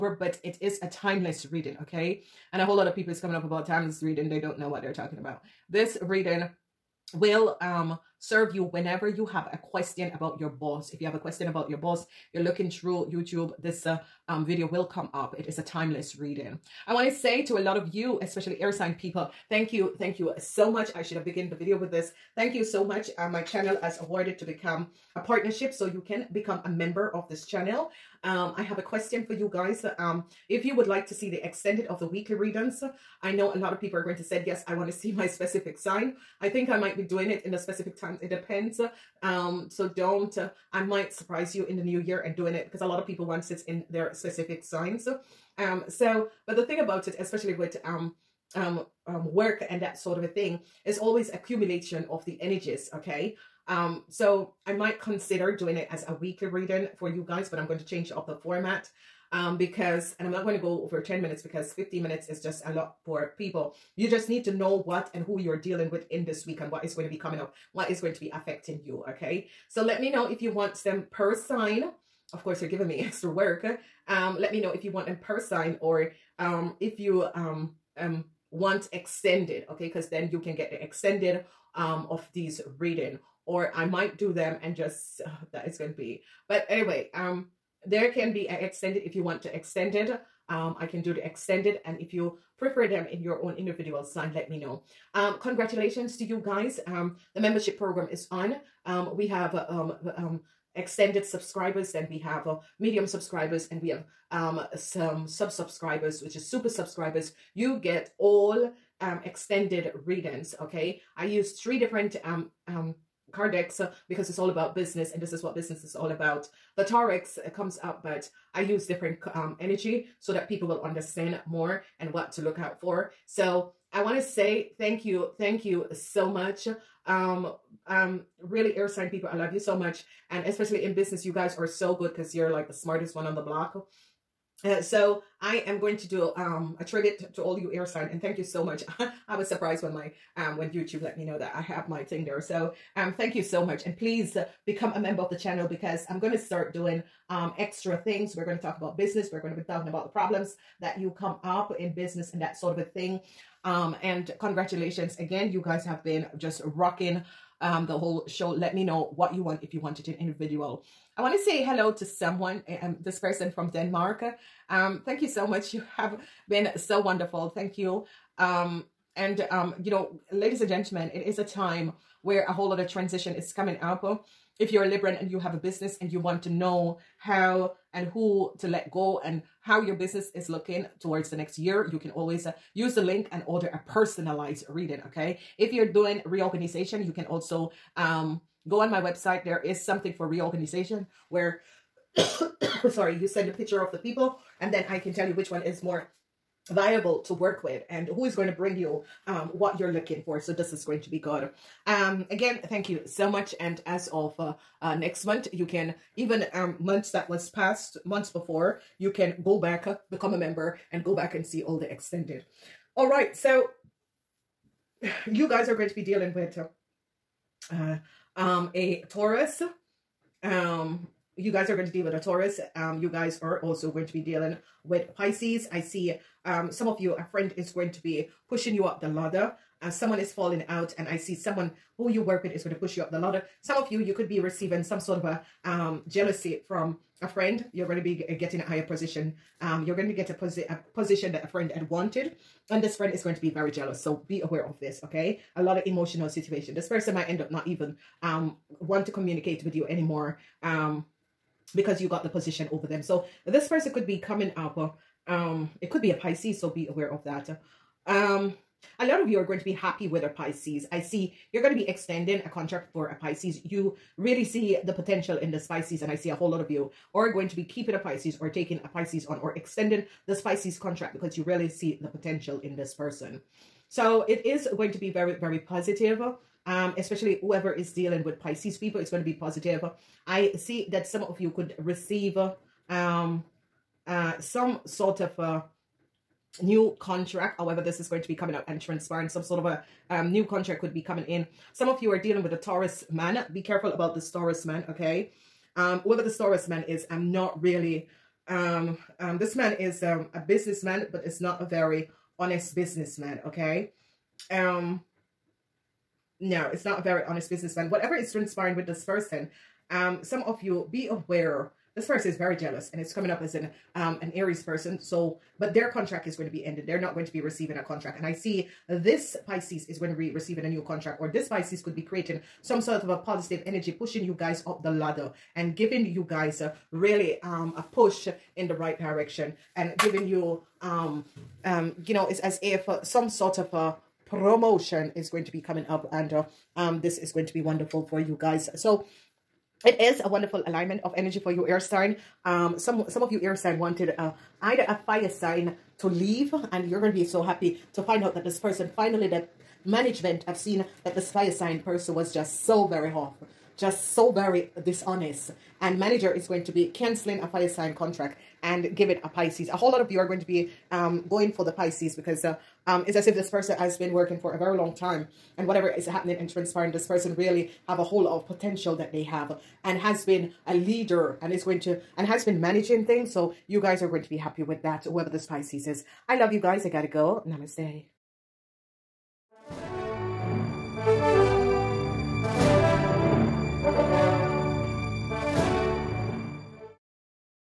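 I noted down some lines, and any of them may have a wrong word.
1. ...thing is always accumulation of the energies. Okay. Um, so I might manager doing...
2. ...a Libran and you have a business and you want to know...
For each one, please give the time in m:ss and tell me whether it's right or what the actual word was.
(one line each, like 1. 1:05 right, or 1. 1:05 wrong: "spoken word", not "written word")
1. 0:50 wrong: "consider", not "manager"
2. 2:54 right.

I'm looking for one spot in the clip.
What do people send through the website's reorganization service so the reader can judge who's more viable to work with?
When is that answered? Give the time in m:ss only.
3:13.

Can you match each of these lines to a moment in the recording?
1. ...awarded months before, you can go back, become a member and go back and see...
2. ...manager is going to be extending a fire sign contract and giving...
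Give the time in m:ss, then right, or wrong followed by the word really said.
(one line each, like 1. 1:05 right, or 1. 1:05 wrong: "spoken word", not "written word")
1. 3:27 wrong: "passed", not "awarded"
2. 5:55 wrong: "canceling", not "extending".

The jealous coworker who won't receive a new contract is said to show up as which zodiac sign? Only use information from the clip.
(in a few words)
Aries.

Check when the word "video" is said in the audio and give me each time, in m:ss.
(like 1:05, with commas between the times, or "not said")
0:14, 0:21.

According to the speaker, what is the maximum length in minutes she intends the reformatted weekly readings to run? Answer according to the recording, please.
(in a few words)
10.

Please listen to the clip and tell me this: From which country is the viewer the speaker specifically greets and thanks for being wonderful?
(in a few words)
Denmark.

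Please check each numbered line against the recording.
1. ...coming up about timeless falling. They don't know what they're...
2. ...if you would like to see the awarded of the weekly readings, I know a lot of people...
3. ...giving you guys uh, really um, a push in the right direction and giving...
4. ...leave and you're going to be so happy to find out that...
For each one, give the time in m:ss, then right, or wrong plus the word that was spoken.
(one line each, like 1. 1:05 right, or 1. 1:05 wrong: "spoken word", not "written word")
1. 0:03 wrong: "reading", not "falling"
2. 0:30 wrong: "extended", not "awarded"
3. 5:25 right
4. 5:46 right.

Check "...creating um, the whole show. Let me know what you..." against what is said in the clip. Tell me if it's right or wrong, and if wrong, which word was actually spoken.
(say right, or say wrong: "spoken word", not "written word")
wrong: "rocking", not "creating".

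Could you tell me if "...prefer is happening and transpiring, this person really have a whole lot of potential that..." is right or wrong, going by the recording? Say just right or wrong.
wrong.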